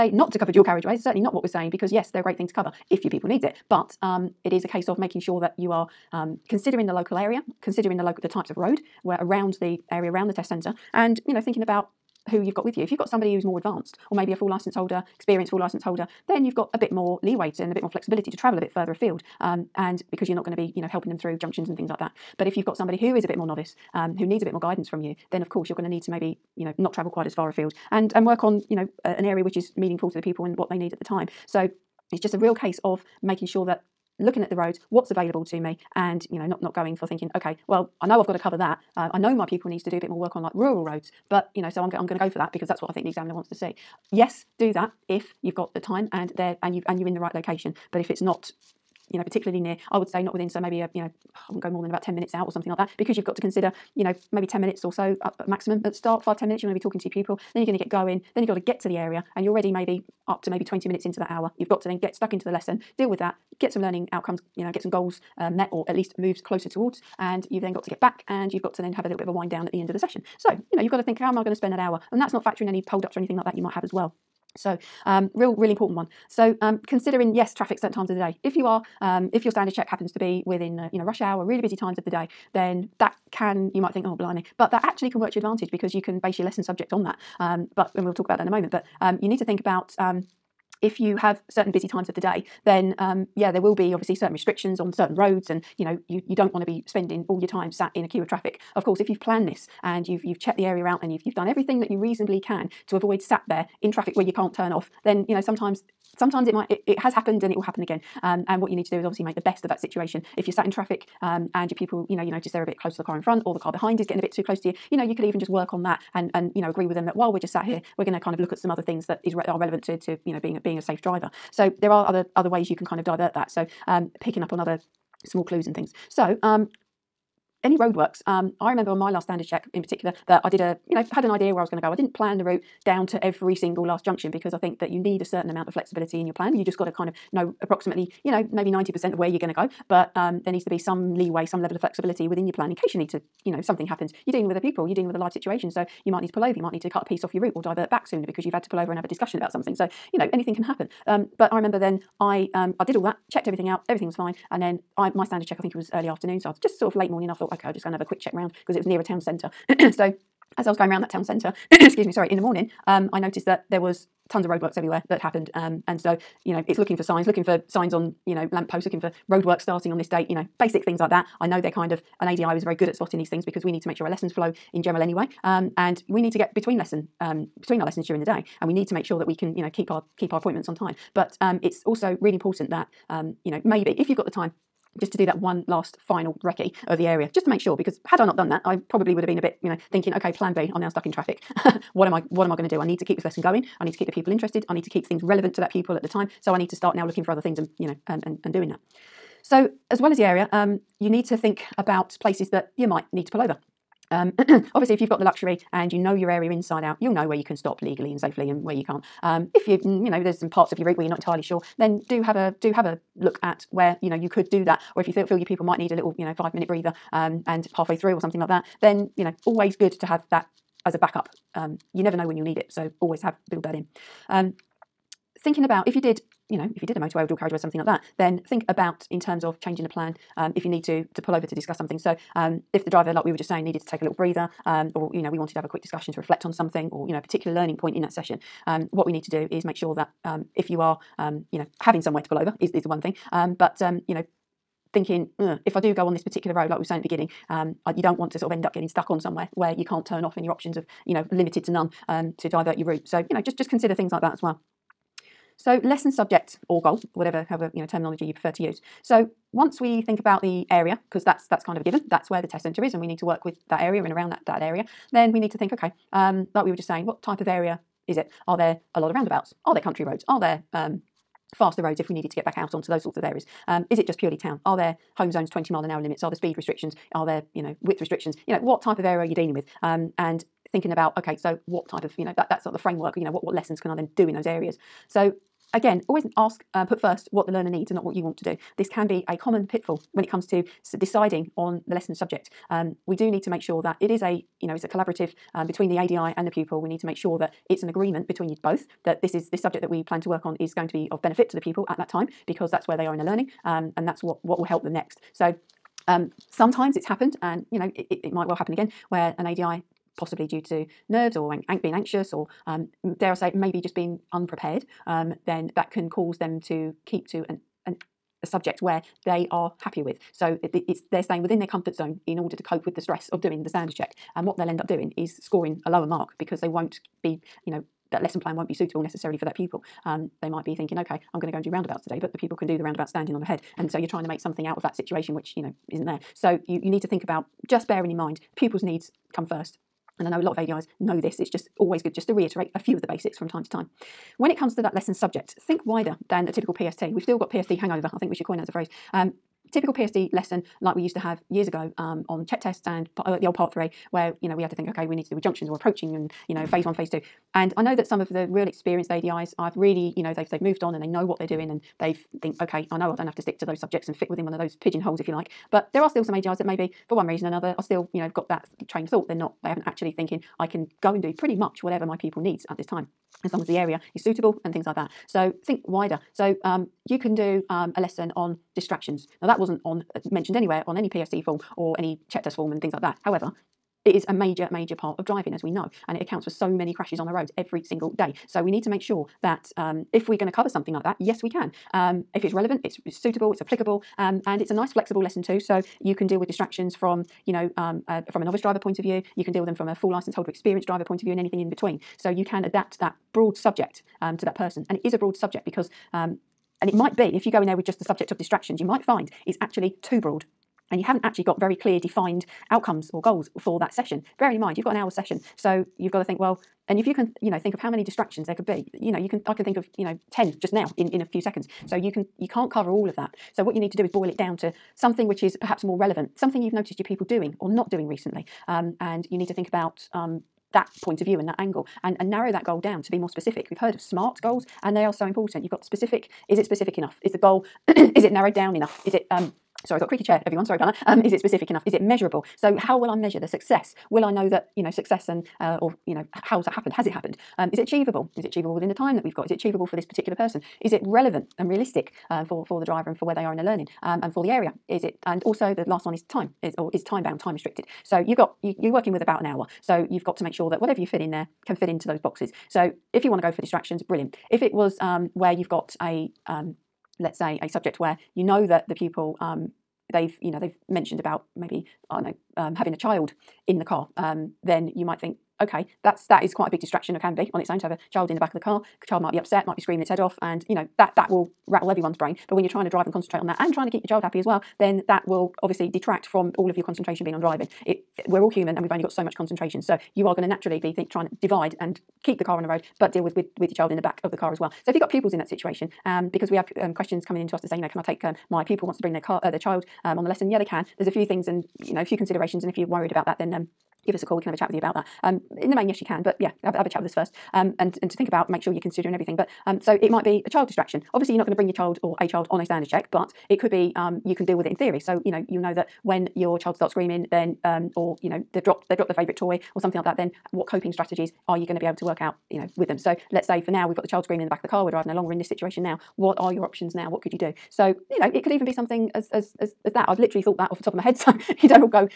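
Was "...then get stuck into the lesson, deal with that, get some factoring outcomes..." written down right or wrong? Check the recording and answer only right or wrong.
wrong.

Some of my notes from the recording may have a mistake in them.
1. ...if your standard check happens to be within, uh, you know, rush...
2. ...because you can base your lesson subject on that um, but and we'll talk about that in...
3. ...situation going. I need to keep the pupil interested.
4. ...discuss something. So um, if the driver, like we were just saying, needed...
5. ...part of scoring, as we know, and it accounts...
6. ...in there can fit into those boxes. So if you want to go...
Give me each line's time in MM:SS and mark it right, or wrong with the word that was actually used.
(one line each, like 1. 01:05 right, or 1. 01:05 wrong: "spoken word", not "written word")
1. 01:19 right
2. 01:25 right
3. 03:13 wrong: "lesson", not "situation"
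4. 03:51 right
5. 06:24 wrong: "driving", not "scoring"
6. 07:41 right.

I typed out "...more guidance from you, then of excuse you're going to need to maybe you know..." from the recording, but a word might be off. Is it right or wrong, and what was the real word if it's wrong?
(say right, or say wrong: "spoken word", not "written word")
wrong: "course", not "excuse".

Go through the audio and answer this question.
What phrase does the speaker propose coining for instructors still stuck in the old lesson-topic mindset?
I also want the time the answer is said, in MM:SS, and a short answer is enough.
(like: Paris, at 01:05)
PST hangover, at 05:47.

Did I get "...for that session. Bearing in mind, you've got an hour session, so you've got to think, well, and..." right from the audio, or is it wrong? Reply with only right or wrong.
right.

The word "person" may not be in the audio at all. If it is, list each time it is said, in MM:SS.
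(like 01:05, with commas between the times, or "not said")
06:44, 07:30.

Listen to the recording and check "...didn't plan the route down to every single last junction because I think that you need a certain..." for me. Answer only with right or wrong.
right.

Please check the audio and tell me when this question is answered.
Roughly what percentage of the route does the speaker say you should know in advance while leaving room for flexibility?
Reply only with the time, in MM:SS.
02:18.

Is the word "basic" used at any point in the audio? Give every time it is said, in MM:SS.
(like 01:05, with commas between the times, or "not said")
02:50, 05:43.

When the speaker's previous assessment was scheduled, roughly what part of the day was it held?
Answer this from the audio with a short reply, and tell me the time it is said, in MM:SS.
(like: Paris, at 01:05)
early afternoon, at 02:35.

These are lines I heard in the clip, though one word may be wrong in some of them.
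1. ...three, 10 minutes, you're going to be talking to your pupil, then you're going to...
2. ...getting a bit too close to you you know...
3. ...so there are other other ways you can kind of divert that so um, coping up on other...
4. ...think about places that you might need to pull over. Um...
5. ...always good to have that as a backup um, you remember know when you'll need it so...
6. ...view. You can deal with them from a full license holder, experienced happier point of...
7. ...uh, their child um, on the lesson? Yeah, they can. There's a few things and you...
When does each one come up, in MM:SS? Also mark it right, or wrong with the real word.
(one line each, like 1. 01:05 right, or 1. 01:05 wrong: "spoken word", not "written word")
1. 00:56 wrong: "five", not "three"
2. 01:54 right
3. 02:01 wrong: "picking", not "coping"
4. 03:21 right
5. 03:39 wrong: "never", not "remember"
6. 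06:39 wrong: "driver", not "happier"
7. 08:19 right.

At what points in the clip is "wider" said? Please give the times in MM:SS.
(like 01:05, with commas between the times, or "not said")
05:45, 06:15.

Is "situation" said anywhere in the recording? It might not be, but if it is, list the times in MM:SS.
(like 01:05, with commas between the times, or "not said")
01:49, 02:25, 05:34, 08:15, 08:45.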